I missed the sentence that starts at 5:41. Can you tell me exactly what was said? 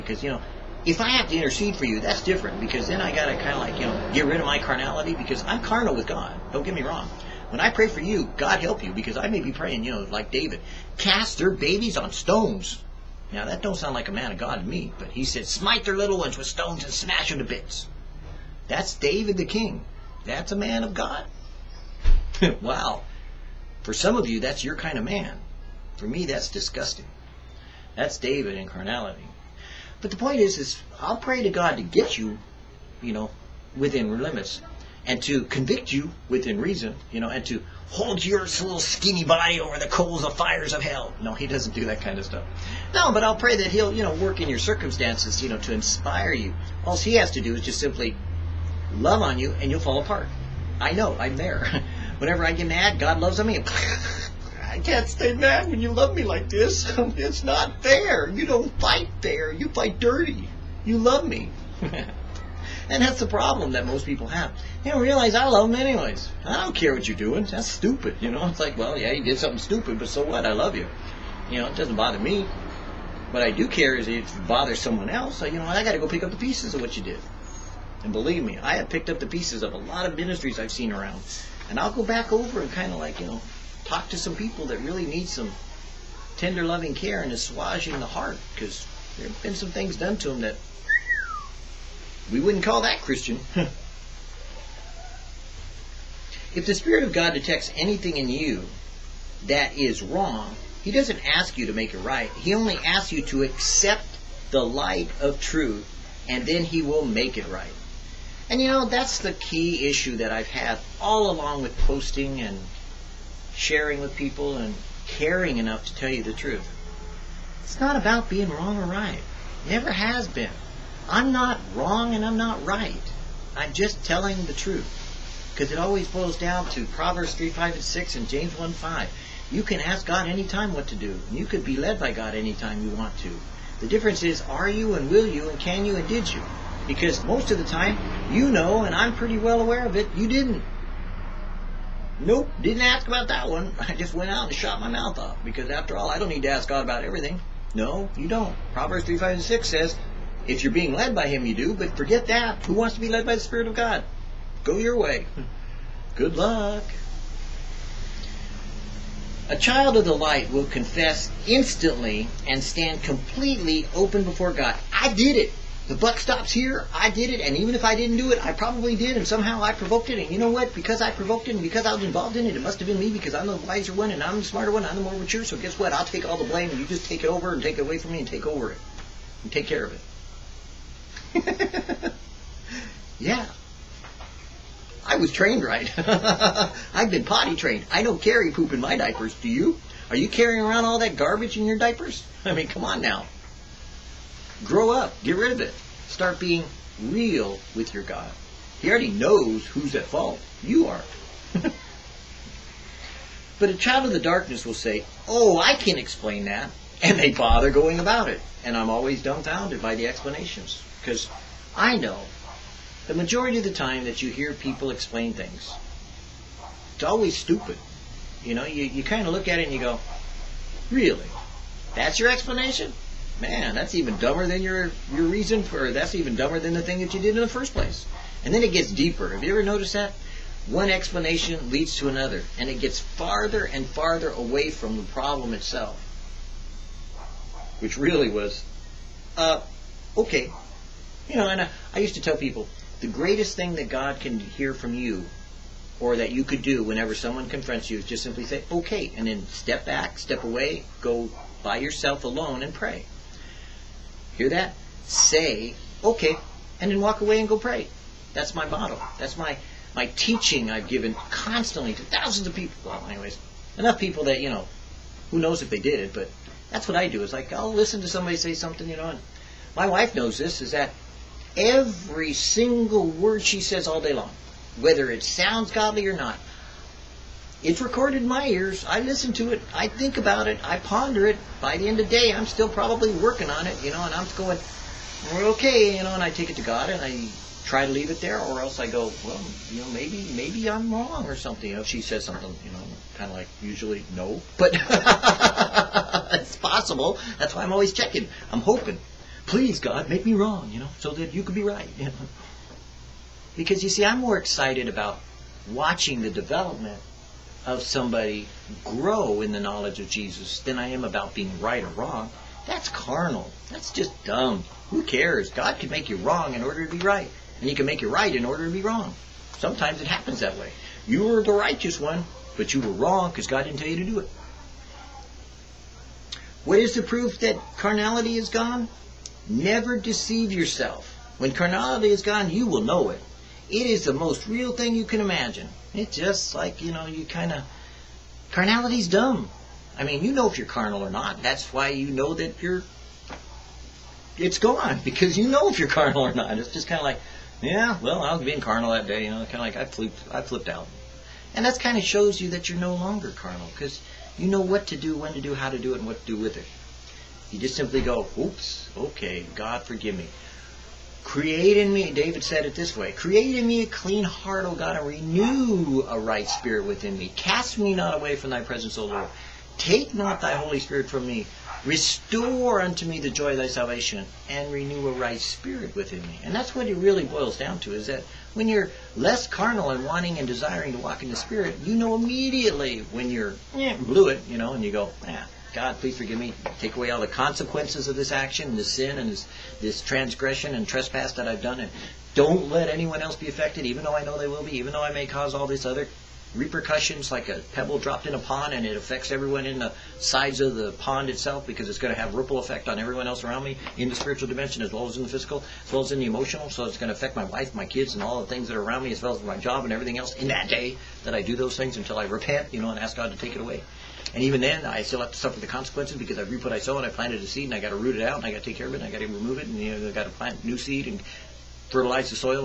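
That's why you know that you're...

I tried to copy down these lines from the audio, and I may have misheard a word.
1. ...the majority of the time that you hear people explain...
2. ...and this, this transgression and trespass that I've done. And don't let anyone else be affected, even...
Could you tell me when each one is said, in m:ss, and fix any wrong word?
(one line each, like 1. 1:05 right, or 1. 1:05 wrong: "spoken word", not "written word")
1. 3:33 right
2. 6:29 right.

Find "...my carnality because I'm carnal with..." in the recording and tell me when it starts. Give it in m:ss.
0:04.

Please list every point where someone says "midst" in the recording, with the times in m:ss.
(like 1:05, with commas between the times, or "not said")
not said.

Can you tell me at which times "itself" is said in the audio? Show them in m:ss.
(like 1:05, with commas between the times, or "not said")
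3:55, 6:41.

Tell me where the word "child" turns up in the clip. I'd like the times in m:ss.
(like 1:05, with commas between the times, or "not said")
2:39, 3:23.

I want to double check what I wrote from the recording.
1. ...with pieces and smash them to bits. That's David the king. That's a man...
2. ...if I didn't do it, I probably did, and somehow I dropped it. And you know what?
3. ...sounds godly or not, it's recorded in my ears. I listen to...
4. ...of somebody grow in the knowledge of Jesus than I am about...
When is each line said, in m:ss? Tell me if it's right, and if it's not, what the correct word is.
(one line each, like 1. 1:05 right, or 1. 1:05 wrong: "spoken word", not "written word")
1. 0:16 wrong: "stones", not "pieces"
2. 2:47 wrong: "provoked", not "dropped"
3. 4:35 right
4. 5:07 right.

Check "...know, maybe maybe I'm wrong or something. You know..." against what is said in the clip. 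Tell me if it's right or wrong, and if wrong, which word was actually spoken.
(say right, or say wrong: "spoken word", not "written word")
right.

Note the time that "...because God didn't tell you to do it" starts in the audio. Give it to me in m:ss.
5:23.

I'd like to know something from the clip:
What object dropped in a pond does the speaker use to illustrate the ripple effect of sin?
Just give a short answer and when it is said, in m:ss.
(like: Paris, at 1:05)
pebble, at 6:37.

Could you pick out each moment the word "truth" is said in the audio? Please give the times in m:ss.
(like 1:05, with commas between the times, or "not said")
1:45, 1:56, 2:04.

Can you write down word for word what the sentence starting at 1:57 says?
It's not about being wrong or right.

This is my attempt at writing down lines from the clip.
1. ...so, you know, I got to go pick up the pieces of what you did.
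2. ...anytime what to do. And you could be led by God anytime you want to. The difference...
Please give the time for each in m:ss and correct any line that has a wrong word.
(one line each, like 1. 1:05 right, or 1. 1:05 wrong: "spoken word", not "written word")
1. 1:15 right
2. 2:10 right.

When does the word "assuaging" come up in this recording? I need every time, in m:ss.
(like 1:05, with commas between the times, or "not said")
1:27.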